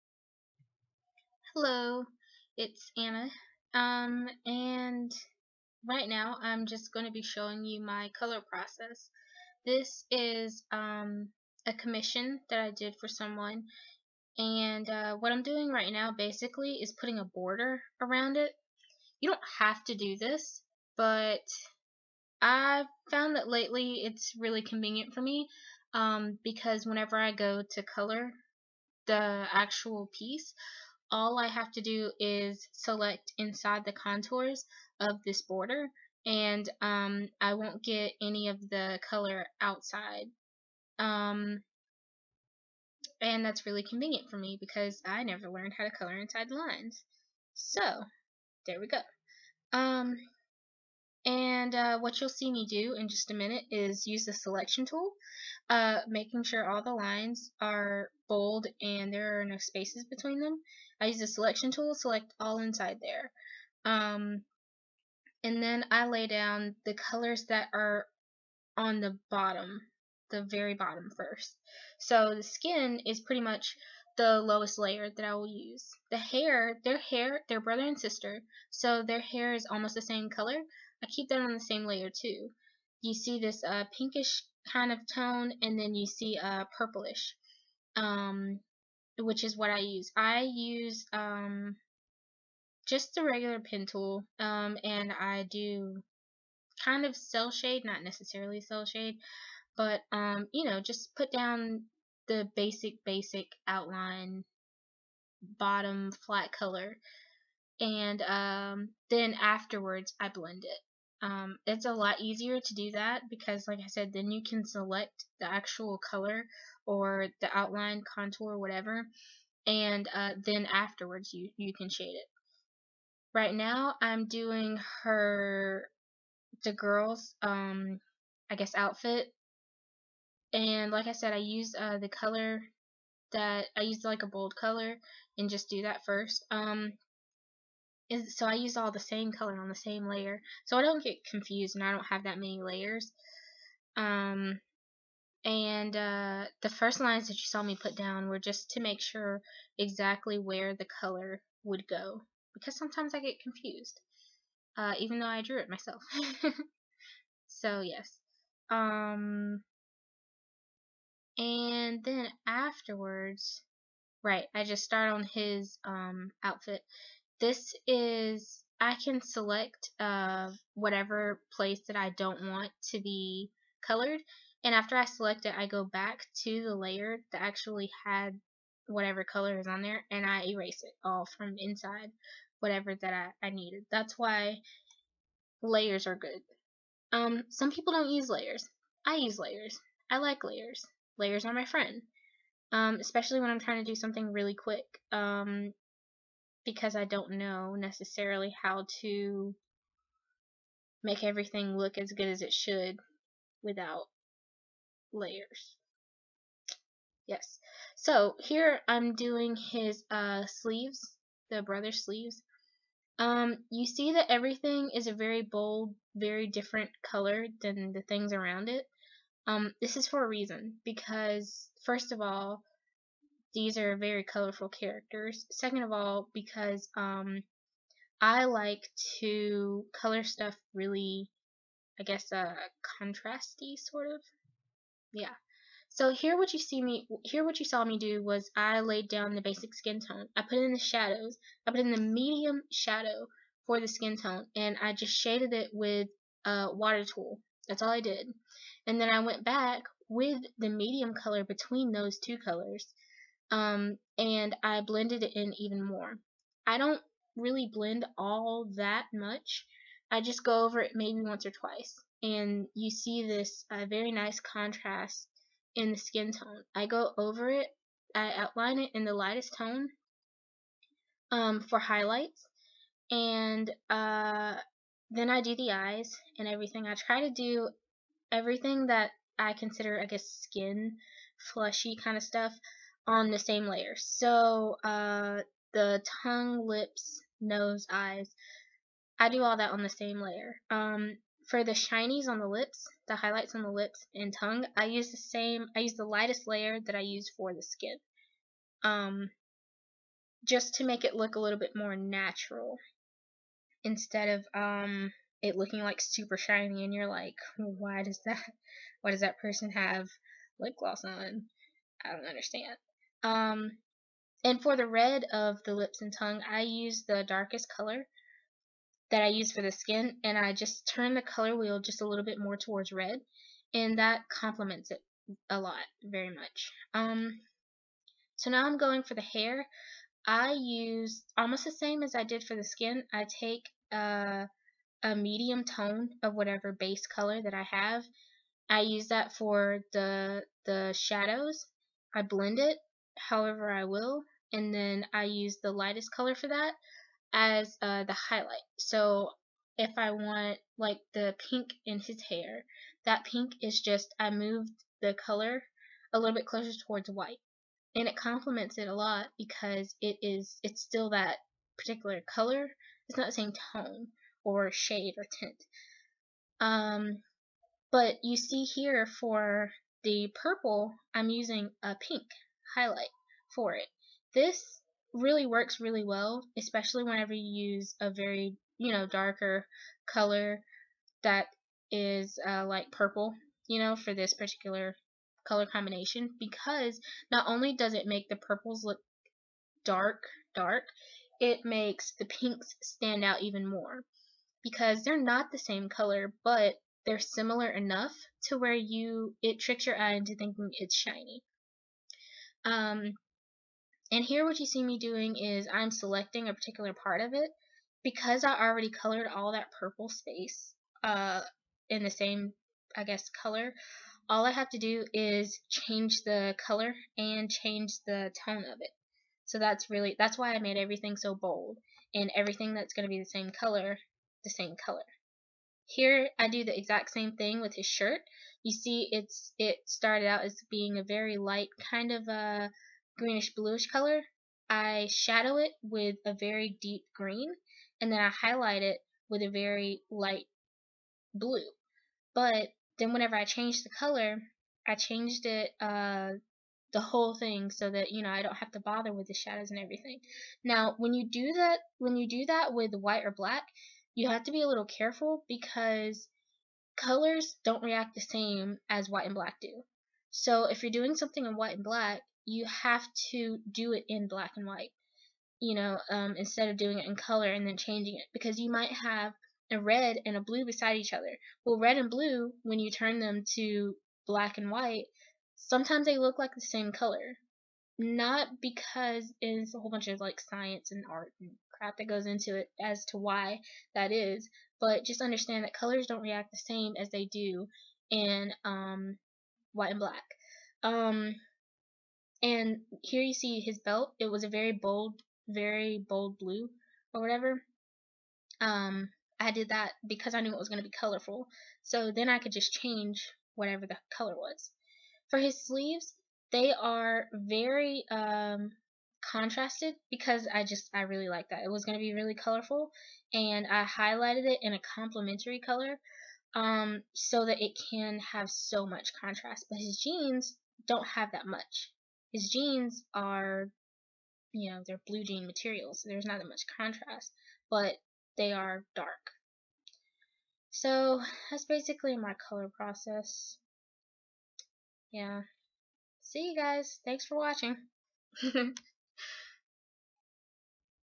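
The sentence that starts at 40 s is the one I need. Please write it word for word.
Um, and that's really convenient for me because I never learned how to color inside the lines.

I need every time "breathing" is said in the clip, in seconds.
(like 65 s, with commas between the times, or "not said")
not said.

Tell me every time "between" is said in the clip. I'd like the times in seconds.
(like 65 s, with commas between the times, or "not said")
60 s, 251 s.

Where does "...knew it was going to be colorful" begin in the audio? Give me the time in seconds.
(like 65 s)
500 s.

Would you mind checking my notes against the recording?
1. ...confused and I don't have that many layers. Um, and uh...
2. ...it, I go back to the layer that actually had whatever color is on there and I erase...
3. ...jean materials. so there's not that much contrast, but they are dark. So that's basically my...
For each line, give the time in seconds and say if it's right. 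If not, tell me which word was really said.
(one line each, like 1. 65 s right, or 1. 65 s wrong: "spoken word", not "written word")
1. 141 s right
2. 175 s right
3. 525 s right.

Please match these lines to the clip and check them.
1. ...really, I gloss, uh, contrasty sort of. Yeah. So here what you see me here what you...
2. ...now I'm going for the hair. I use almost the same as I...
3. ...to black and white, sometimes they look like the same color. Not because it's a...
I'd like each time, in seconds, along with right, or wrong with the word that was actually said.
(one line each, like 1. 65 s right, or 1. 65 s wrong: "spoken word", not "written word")
1. 230 s wrong: "guess", not "gloss"
2. 328 s right
3. 473 s right.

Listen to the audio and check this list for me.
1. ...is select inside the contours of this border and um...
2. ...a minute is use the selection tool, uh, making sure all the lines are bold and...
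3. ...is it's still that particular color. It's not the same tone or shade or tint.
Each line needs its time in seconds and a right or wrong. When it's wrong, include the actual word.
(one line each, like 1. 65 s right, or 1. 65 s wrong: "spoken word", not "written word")
1. 32 s right
2. 53 s right
3. 360 s right.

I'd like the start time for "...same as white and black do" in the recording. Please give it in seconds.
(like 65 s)
458 s.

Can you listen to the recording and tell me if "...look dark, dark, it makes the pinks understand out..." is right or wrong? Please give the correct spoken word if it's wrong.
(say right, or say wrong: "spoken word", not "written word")
wrong: "stand", not "understand".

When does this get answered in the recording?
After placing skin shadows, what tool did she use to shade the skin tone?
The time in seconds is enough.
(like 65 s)
246 s.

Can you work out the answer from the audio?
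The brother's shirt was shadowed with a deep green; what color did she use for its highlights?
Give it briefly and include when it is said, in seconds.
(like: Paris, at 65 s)
Light blue, at 439 s.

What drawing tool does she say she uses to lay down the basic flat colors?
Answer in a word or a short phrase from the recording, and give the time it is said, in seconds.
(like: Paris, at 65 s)
Regular pen tool, at 93 s.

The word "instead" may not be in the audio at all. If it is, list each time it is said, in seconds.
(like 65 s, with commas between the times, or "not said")
303 s, 466 s.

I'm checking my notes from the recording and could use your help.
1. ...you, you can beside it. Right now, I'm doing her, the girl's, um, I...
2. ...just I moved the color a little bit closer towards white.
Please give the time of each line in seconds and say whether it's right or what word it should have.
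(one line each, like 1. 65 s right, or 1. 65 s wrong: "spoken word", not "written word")
1. 121 s wrong: "shade", not "beside"
2. 353 s right.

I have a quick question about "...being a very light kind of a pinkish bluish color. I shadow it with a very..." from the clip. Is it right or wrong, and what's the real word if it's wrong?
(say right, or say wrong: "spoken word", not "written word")
wrong: "greenish", not "pinkish".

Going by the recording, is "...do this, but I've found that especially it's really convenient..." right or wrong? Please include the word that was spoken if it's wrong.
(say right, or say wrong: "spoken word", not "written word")
wrong: "lately", not "especially".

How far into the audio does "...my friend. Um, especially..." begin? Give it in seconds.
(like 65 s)
191 s.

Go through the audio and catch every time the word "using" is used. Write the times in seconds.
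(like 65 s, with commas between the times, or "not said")
371 s.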